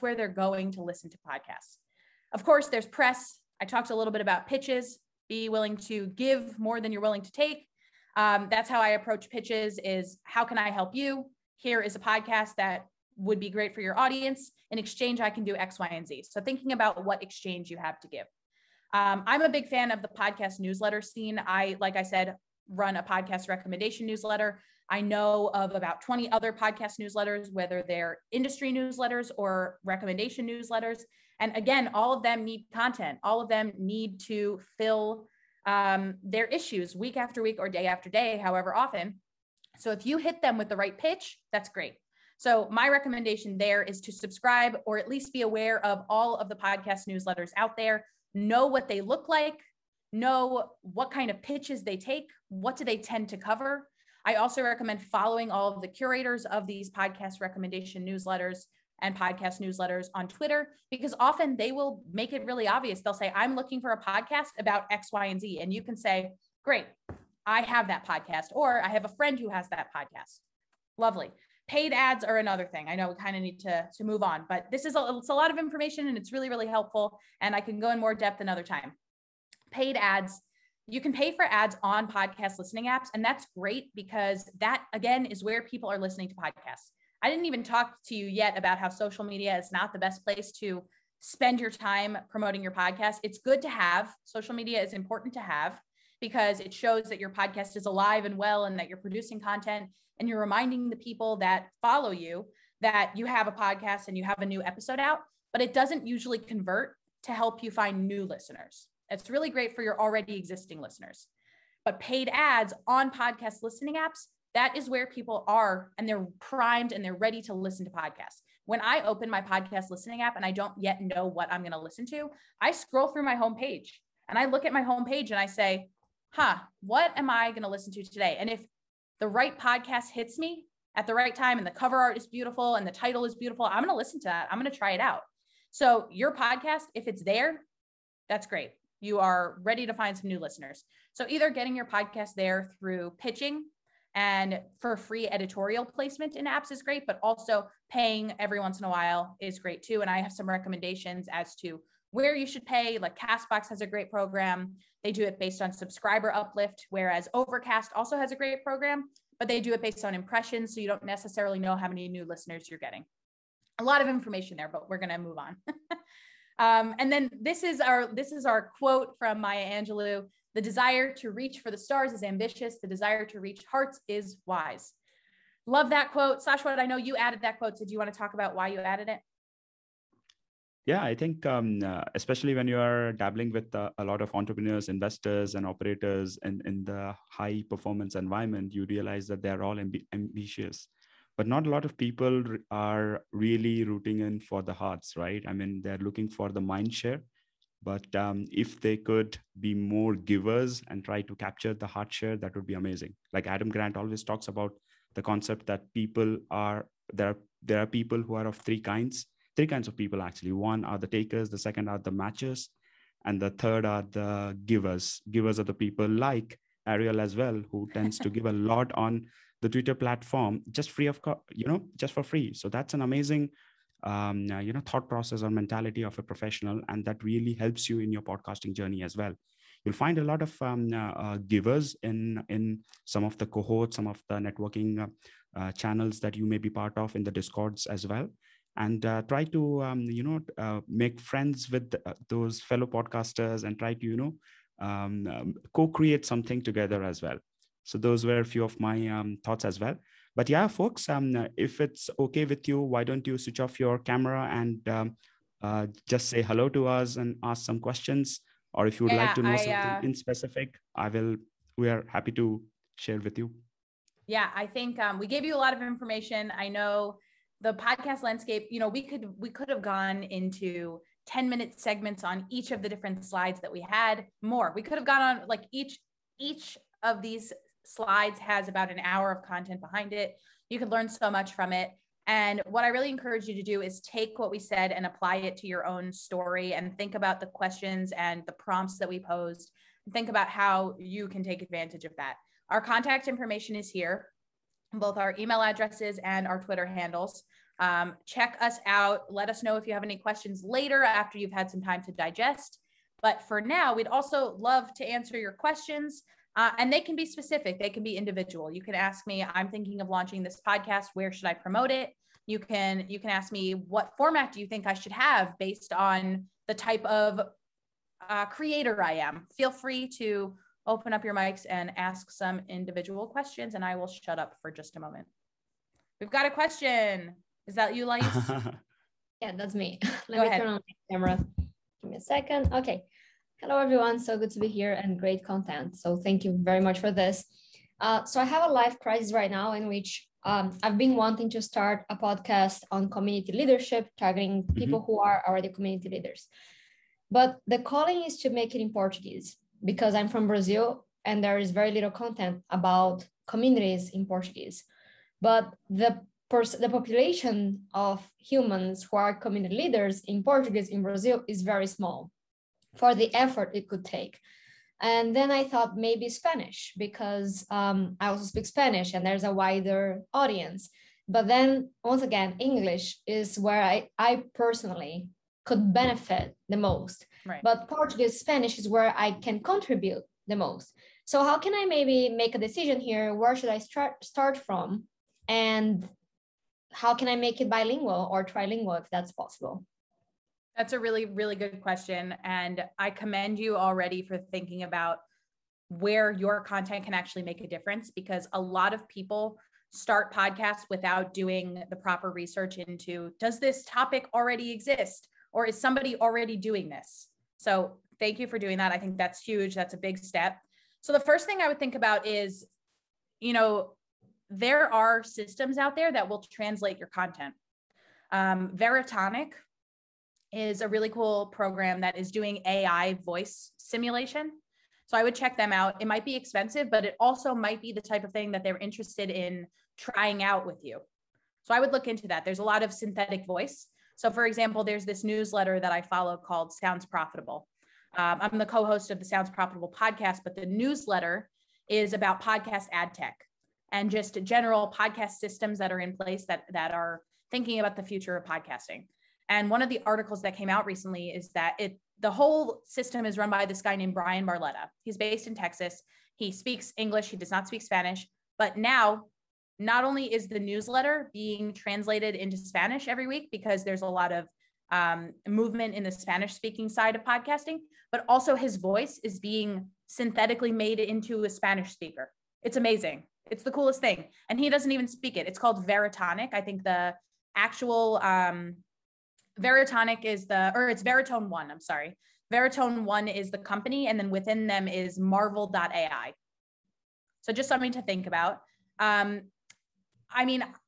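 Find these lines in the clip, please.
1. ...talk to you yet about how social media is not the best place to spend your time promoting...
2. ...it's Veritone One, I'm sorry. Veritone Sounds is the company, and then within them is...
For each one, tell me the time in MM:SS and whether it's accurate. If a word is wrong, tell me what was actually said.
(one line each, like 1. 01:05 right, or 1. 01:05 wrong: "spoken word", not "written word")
1. 01:27 right
2. 08:00 wrong: "One", not "Sounds".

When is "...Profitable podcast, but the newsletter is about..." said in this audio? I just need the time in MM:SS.
07:19.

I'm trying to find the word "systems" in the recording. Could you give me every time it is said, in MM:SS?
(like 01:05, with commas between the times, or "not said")
06:55, 07:25, 07:32.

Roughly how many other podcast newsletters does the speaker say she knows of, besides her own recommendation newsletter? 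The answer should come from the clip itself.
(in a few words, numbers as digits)
20.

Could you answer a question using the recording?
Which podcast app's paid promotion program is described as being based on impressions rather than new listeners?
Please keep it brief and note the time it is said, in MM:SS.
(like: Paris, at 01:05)
Overcast, at 02:37.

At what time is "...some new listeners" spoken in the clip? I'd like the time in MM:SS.
02:20.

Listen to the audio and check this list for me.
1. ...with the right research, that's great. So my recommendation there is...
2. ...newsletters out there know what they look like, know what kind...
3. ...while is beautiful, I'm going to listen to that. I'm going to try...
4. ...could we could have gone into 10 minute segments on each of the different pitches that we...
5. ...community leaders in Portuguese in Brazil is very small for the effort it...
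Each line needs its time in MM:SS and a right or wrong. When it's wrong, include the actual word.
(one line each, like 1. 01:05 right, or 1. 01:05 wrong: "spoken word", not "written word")
1. 00:40 wrong: "pitch", not "research"
2. 00:47 right
3. 02:12 wrong: "title", not "while"
4. 04:29 wrong: "slides", not "pitches"
5. 05:59 right.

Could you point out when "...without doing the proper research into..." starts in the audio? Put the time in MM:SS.
06:40.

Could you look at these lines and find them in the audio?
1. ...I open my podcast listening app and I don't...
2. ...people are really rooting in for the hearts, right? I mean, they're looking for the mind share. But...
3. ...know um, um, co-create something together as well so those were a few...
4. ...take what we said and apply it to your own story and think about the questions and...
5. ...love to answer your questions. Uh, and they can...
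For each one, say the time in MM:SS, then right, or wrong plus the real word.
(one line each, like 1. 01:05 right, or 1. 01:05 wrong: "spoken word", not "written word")
1. 01:58 right
2. 03:11 right
3. 04:04 right
4. 04:43 right
5. 05:04 right.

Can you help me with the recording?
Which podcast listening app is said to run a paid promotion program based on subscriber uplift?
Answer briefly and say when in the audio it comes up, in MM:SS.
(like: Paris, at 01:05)
Castbox, at 02:33.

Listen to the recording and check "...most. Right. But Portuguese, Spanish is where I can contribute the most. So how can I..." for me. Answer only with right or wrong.
right.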